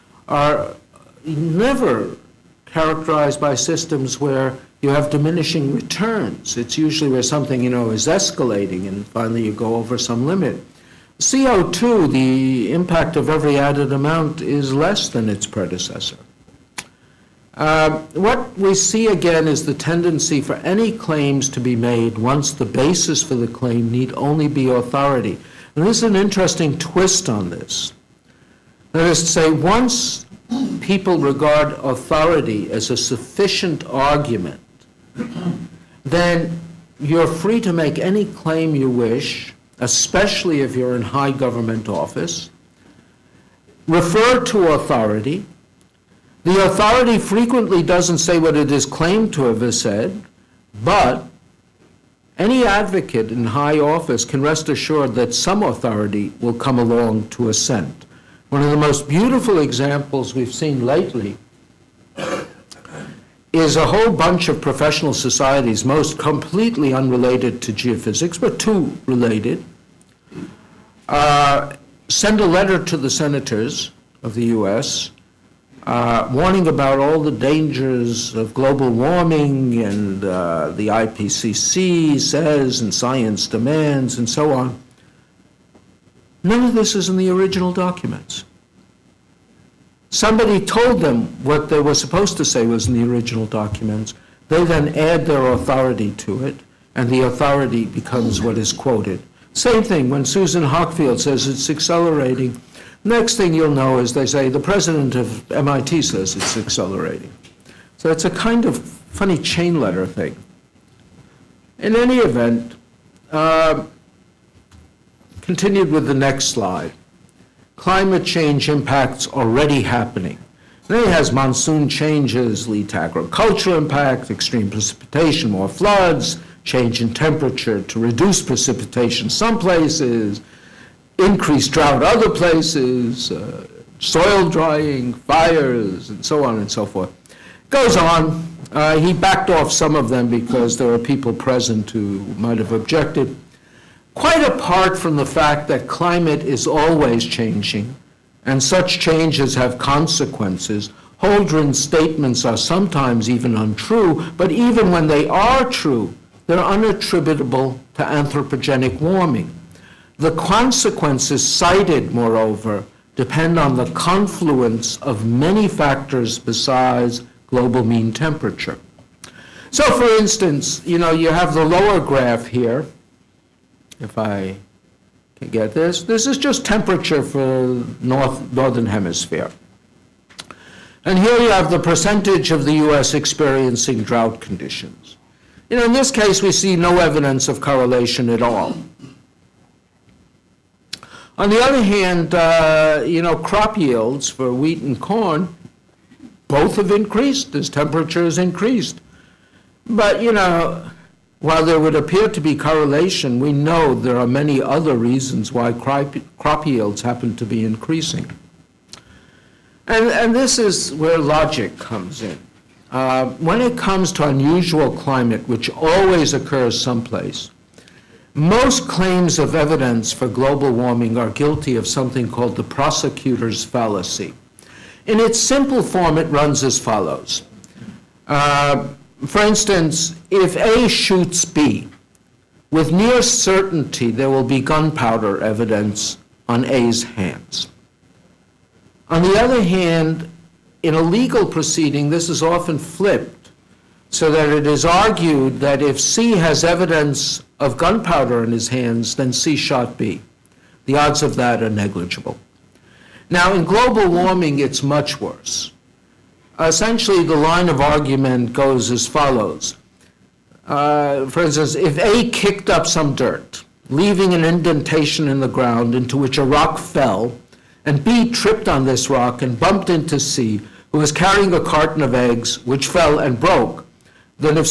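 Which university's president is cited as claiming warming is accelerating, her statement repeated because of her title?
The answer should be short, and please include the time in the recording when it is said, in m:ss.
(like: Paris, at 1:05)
MIT, at 1:45.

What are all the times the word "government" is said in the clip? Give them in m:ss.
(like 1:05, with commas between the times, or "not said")
0:41.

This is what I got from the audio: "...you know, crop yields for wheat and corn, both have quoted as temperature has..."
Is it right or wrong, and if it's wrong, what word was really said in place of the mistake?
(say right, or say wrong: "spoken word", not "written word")
wrong: "increased", not "quoted".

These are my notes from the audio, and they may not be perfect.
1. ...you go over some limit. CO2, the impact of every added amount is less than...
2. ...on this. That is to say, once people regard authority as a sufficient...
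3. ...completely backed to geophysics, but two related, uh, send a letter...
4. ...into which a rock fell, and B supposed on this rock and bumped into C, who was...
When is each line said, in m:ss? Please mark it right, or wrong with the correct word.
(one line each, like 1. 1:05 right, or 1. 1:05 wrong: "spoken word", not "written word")
1. 0:09 right
2. 0:27 right
3. 1:06 wrong: "unrelated", not "backed"
4. 4:25 wrong: "tripped", not "supposed".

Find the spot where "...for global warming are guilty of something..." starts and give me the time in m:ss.
3:40.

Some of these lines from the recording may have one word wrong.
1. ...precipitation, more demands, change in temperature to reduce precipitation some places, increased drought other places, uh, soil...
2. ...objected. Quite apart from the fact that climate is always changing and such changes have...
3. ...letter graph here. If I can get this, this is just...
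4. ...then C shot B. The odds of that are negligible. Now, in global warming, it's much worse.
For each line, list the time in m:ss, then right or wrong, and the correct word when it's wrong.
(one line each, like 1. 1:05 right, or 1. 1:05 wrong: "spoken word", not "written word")
1. 2:04 wrong: "floods", not "demands"
2. 2:22 right
3. 2:51 wrong: "lower", not "letter"
4. 4:09 right.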